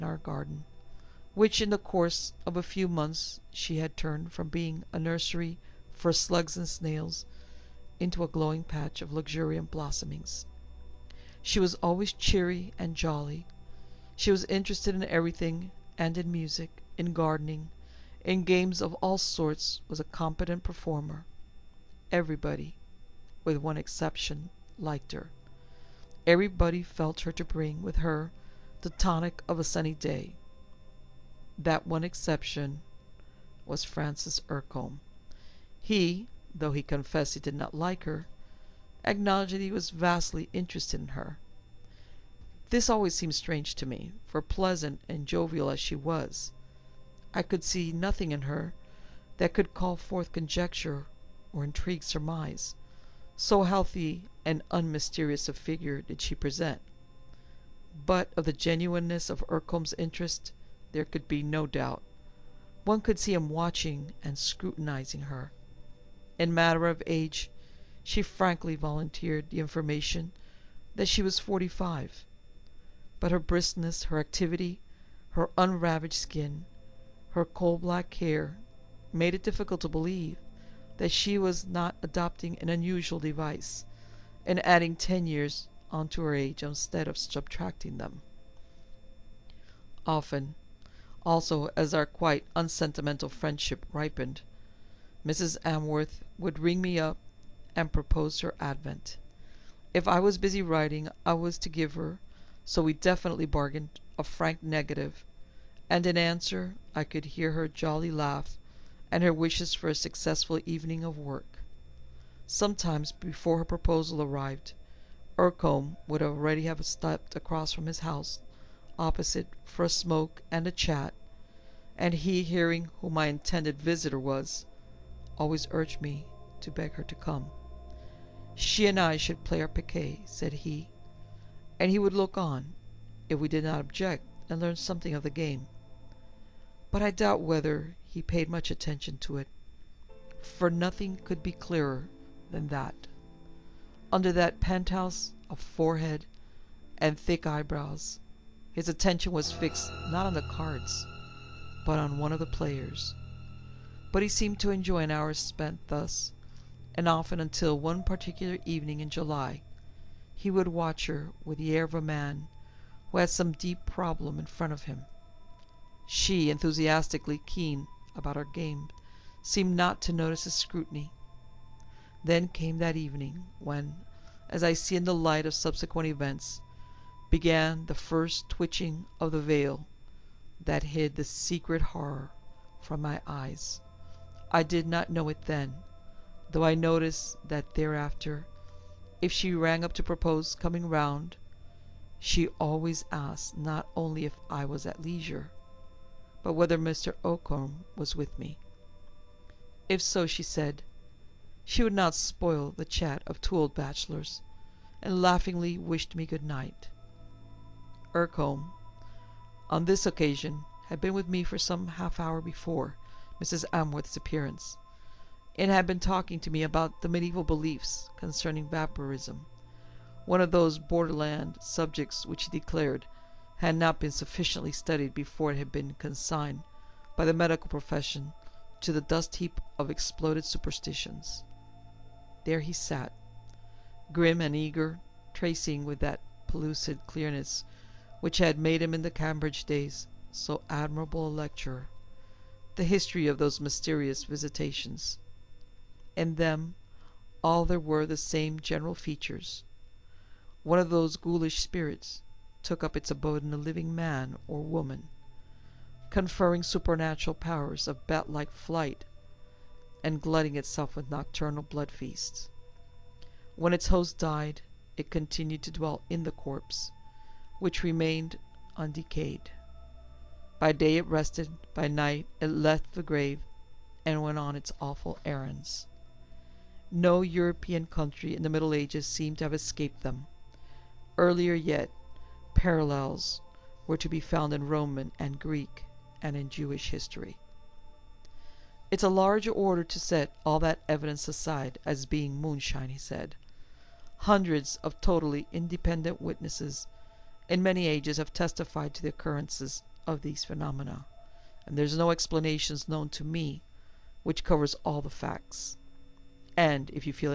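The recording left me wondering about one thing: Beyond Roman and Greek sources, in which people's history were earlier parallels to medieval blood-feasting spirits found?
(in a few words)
Jewish.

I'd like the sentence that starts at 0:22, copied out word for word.
Everybody, with one exception, liked her.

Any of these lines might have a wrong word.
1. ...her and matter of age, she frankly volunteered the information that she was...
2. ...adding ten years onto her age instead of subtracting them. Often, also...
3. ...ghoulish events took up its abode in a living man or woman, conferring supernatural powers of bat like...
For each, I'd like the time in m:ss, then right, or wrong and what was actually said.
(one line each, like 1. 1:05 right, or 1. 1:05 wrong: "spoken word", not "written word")
1. 1:05 right
2. 1:24 right
3. 4:11 wrong: "spirits", not "events".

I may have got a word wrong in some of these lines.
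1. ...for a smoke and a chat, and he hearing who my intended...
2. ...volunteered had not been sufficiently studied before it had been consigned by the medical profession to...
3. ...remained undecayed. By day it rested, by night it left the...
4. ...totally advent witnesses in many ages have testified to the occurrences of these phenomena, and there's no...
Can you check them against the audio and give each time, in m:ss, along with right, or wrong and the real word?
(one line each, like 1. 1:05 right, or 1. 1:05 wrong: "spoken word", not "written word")
1. 1:59 right
2. 3:42 wrong: "declared", not "volunteered"
3. 4:27 right
4. 4:55 wrong: "independent", not "advent".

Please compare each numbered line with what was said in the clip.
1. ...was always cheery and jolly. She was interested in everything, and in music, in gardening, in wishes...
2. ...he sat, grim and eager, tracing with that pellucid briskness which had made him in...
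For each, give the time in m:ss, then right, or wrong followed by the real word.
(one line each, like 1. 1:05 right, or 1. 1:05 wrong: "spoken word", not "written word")
1. 0:11 wrong: "games", not "wishes"
2. 3:52 wrong: "clearness", not "briskness".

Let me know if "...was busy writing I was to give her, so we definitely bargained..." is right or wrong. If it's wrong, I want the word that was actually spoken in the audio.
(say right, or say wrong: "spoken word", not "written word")
right.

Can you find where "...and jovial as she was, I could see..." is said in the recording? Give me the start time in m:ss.
0:45.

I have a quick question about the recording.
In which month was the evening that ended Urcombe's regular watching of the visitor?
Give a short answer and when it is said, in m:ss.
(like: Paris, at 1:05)
July, at 2:39.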